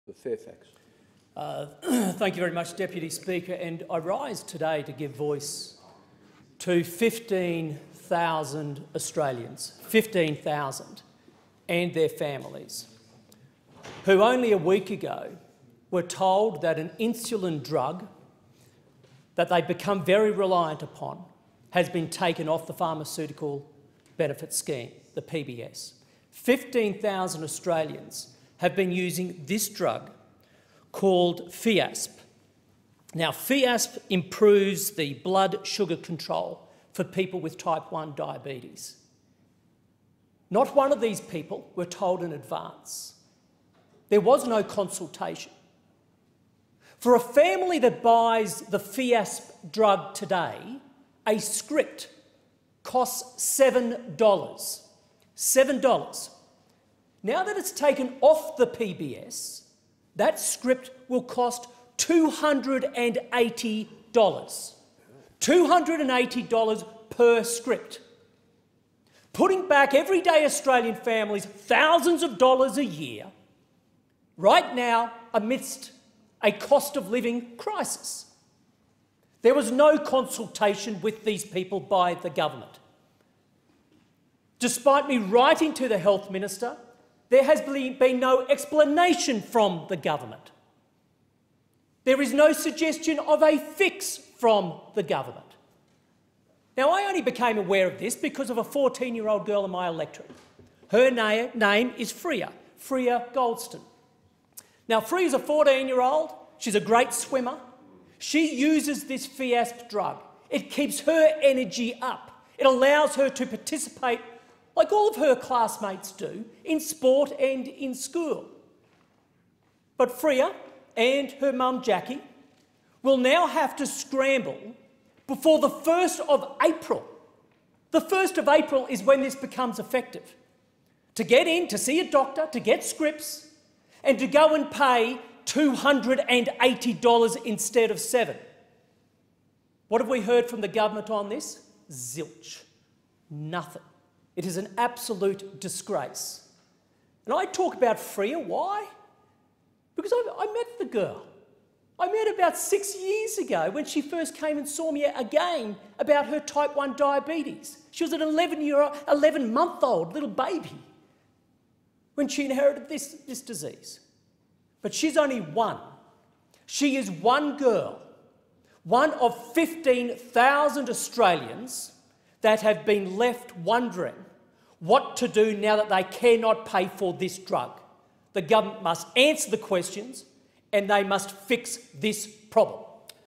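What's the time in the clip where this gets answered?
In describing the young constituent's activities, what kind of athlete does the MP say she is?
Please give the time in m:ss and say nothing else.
1:47.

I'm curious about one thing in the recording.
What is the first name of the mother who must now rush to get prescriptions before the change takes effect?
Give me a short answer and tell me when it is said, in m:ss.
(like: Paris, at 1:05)
Jackie, at 2:01.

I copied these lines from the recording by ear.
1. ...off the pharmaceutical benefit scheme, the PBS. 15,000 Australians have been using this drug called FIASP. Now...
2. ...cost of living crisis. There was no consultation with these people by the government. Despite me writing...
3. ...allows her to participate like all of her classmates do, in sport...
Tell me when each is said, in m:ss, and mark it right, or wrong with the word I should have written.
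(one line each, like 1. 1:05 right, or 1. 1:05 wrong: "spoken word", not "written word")
1. 0:22 right
2. 1:16 right
3. 1:52 right.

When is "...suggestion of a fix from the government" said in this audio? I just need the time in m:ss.
1:32.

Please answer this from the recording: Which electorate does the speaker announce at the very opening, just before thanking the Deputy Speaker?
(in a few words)
Fairfax.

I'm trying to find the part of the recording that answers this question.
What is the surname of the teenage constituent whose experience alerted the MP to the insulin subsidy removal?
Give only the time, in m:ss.
1:43.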